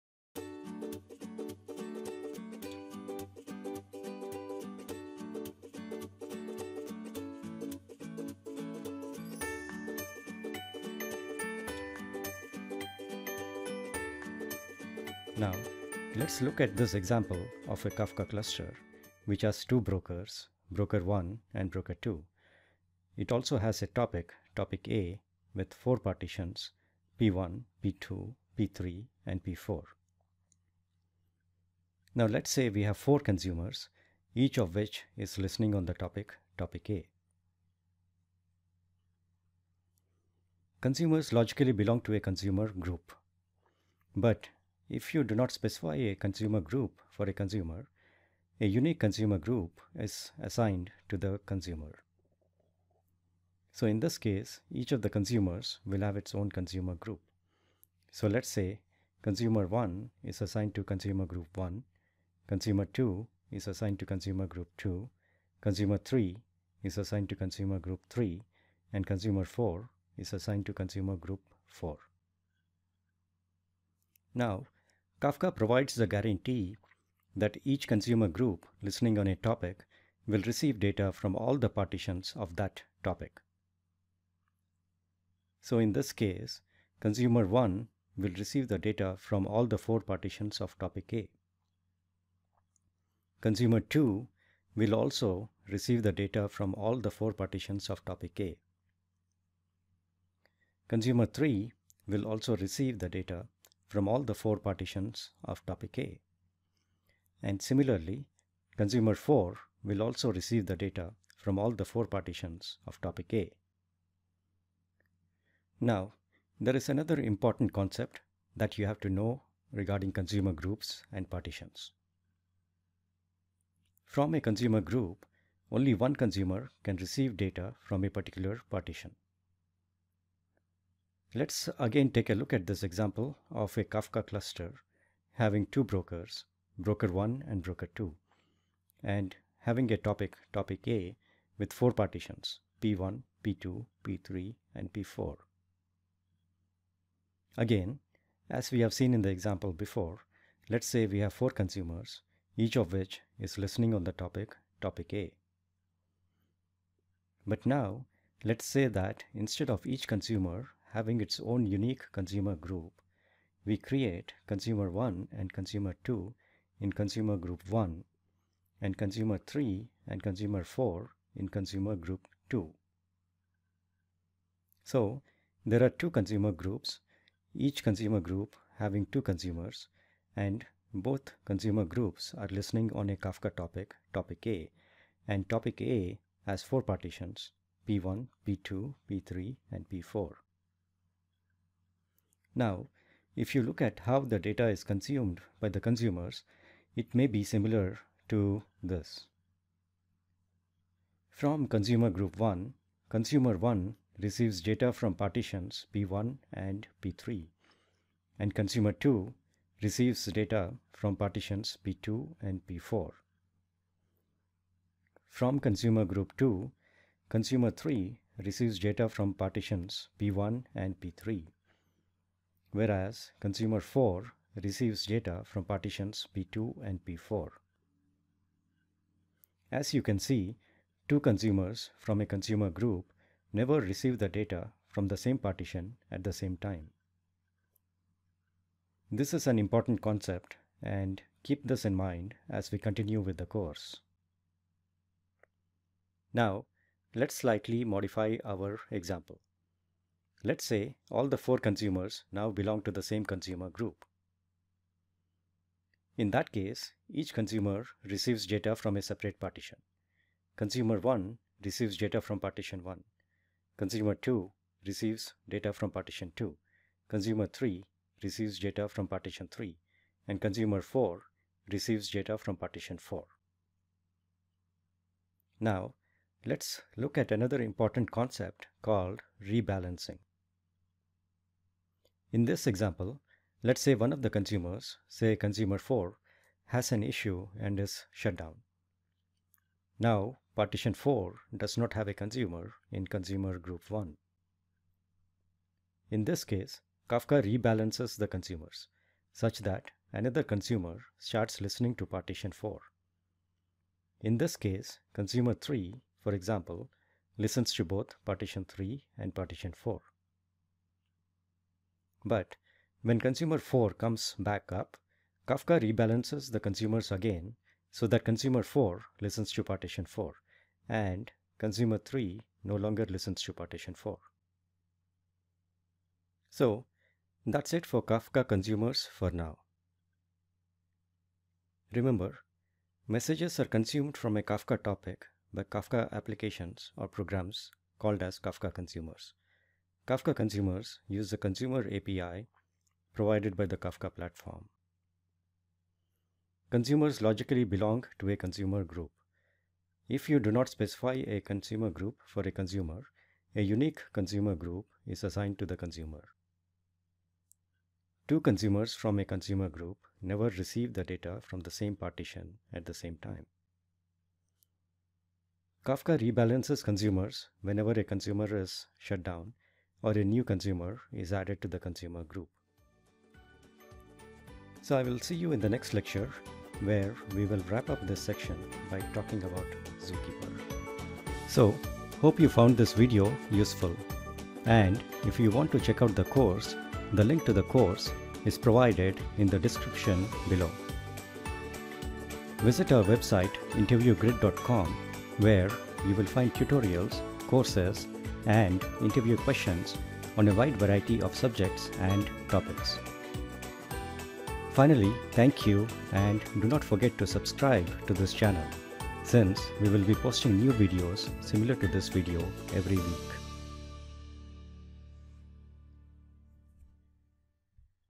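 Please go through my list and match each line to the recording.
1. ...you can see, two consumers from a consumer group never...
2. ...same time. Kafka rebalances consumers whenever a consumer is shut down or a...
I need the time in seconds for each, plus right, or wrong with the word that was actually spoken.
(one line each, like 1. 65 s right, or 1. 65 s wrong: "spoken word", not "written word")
1. 229 s right
2. 362 s right.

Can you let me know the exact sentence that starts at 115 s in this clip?
Now, there is another important concept that you have to know regarding consumer groups and partitions.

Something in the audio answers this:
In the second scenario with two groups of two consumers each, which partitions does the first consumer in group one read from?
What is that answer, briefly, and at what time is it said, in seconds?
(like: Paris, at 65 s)
P1 and P3, at 205 s.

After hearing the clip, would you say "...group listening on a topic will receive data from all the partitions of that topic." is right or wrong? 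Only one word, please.
right.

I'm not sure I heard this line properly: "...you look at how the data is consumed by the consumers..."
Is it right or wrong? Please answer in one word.
right.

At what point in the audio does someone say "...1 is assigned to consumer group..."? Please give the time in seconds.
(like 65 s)
59 s.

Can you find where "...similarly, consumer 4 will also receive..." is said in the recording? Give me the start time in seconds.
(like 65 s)
107 s.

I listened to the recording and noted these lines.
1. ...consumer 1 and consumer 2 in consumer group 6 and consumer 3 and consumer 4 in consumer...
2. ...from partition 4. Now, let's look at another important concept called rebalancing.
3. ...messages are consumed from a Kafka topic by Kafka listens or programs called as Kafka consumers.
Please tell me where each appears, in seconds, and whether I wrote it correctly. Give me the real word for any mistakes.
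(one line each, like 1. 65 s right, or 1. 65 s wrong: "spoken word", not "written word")
1. 164 s wrong: "1", not "6"
2. 272 s right
3. 333 s wrong: "applications", not "listens".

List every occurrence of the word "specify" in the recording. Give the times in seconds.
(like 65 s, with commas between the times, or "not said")
45 s, 350 s.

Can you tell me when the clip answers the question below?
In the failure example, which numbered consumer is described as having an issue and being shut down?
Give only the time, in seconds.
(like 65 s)
285 s.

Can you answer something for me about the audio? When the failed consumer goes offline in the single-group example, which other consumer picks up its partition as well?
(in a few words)
consumer 3.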